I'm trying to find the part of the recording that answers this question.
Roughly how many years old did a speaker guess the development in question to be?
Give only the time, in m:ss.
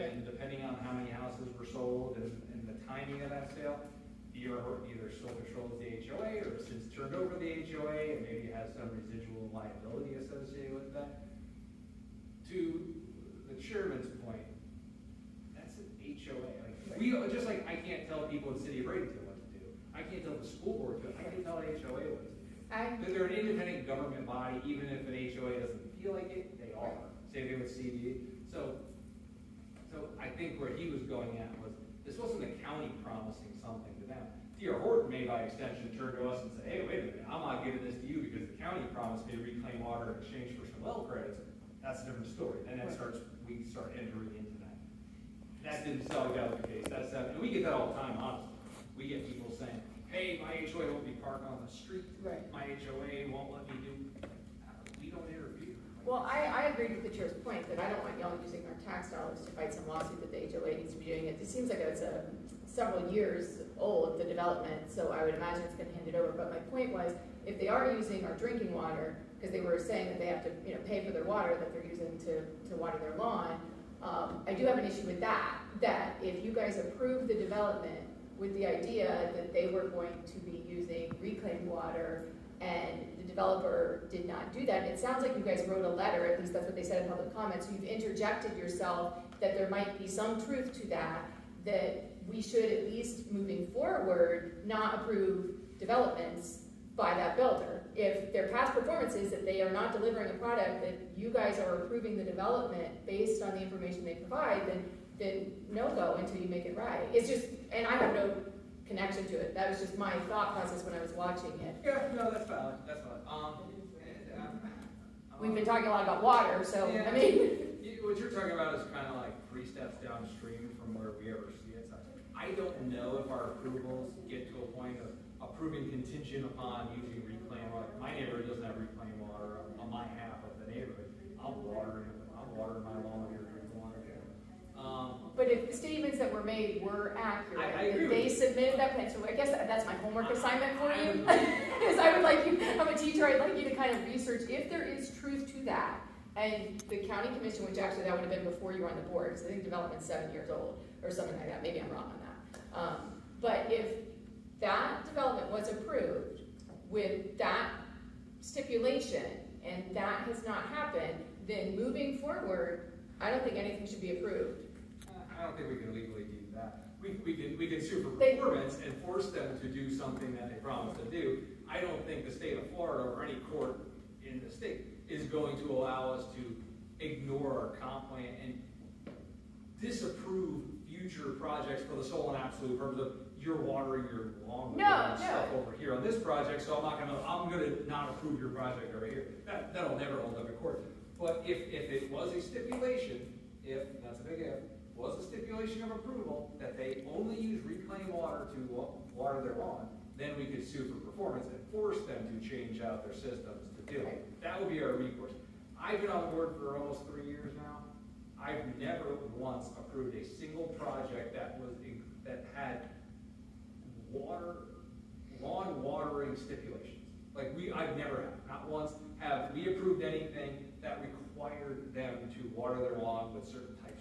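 2:30.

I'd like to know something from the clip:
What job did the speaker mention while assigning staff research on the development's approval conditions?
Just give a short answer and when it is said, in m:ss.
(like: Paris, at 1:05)
Teacher, at 2:22.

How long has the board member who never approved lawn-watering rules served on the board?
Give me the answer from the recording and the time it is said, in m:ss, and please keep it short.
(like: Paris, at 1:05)
almost three years, at 3:26.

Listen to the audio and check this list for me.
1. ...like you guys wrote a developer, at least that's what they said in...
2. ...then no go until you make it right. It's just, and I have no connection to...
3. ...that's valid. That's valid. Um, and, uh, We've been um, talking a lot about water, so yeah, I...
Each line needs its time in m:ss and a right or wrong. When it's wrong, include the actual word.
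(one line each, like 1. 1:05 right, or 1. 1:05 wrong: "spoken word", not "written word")
1. 1:25 wrong: "letter", not "developer"
2. 1:45 right
3. 1:52 right.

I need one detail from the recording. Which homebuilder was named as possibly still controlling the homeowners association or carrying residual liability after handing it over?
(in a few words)
D.R. Horton.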